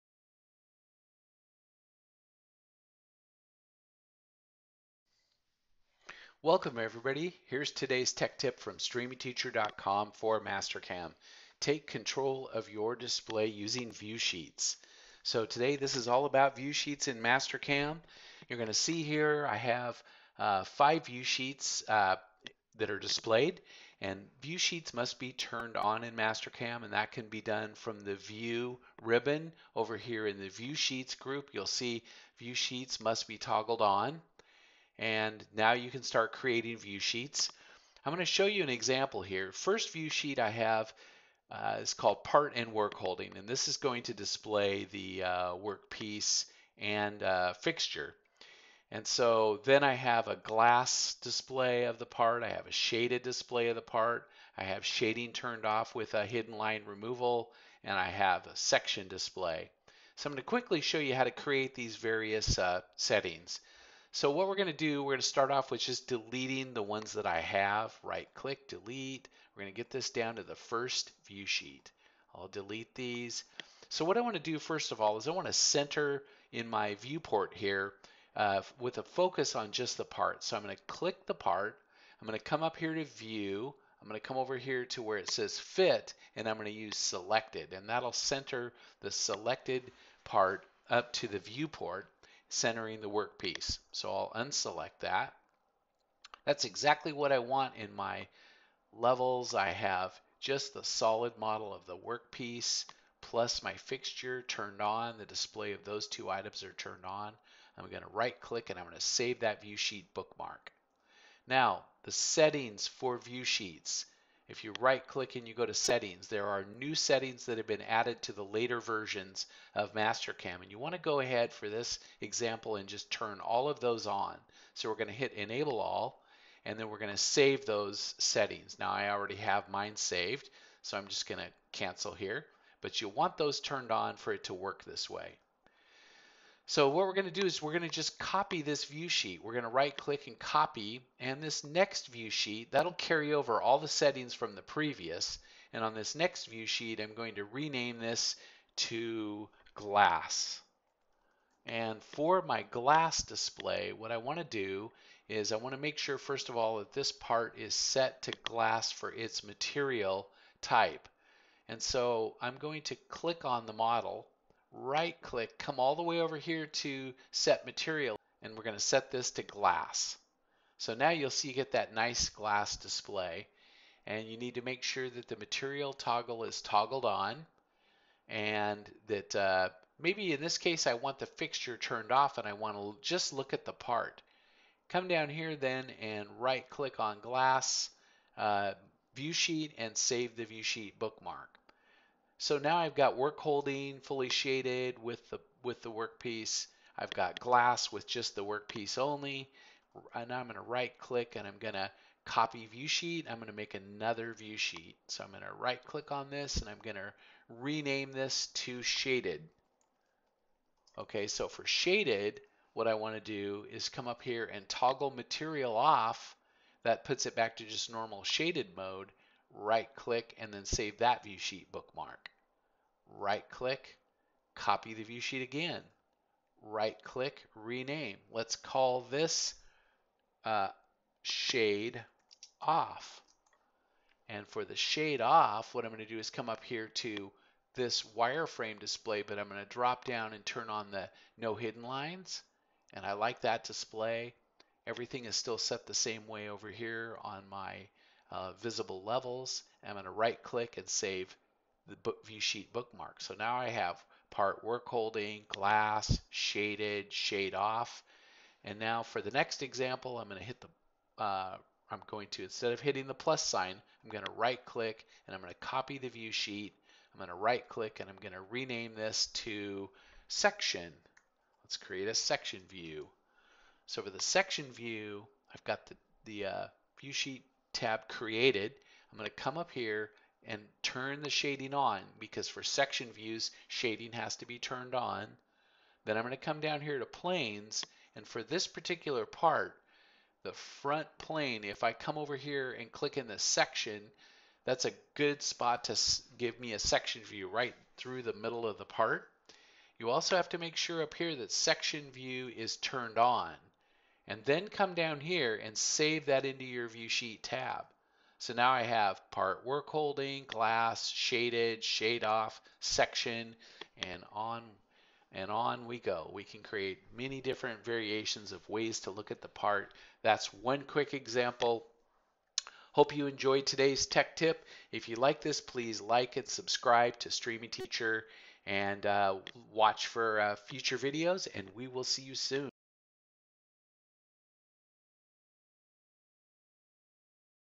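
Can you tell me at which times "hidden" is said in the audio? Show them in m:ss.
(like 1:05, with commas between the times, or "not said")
0:56, 4:01.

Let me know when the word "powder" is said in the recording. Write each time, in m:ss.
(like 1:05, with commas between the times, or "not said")
not said.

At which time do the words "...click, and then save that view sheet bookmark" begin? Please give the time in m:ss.
3:39.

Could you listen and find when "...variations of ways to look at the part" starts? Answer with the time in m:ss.
5:17.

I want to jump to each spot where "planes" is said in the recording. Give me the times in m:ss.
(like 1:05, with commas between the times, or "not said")
4:47, 4:51.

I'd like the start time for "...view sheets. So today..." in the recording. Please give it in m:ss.
0:13.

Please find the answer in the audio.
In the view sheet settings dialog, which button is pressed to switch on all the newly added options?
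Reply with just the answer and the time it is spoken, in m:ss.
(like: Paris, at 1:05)
Enable all, at 2:05.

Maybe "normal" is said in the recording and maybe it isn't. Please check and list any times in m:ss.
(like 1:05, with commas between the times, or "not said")
3:37.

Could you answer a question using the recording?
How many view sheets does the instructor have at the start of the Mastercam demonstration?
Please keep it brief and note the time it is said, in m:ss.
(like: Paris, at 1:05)
5, at 0:20.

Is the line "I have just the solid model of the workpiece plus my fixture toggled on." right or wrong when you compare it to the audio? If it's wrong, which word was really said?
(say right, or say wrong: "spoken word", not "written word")
wrong: "turned", not "toggled".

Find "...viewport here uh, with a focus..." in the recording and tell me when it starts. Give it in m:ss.
1:16.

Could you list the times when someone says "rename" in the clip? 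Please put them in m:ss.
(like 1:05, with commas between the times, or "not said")
2:27, 3:27, 3:47, 4:28.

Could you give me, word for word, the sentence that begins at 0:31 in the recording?
You'll see view sheets must be toggled on.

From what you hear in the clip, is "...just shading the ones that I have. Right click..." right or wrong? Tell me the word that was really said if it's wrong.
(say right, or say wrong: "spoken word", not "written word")
wrong: "deleting", not "shading".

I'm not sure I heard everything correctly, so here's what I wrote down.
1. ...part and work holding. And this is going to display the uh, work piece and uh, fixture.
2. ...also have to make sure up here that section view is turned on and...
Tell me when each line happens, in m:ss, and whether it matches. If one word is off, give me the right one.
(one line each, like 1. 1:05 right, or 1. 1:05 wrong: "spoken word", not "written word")
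1. 0:42 right
2. 5:00 right.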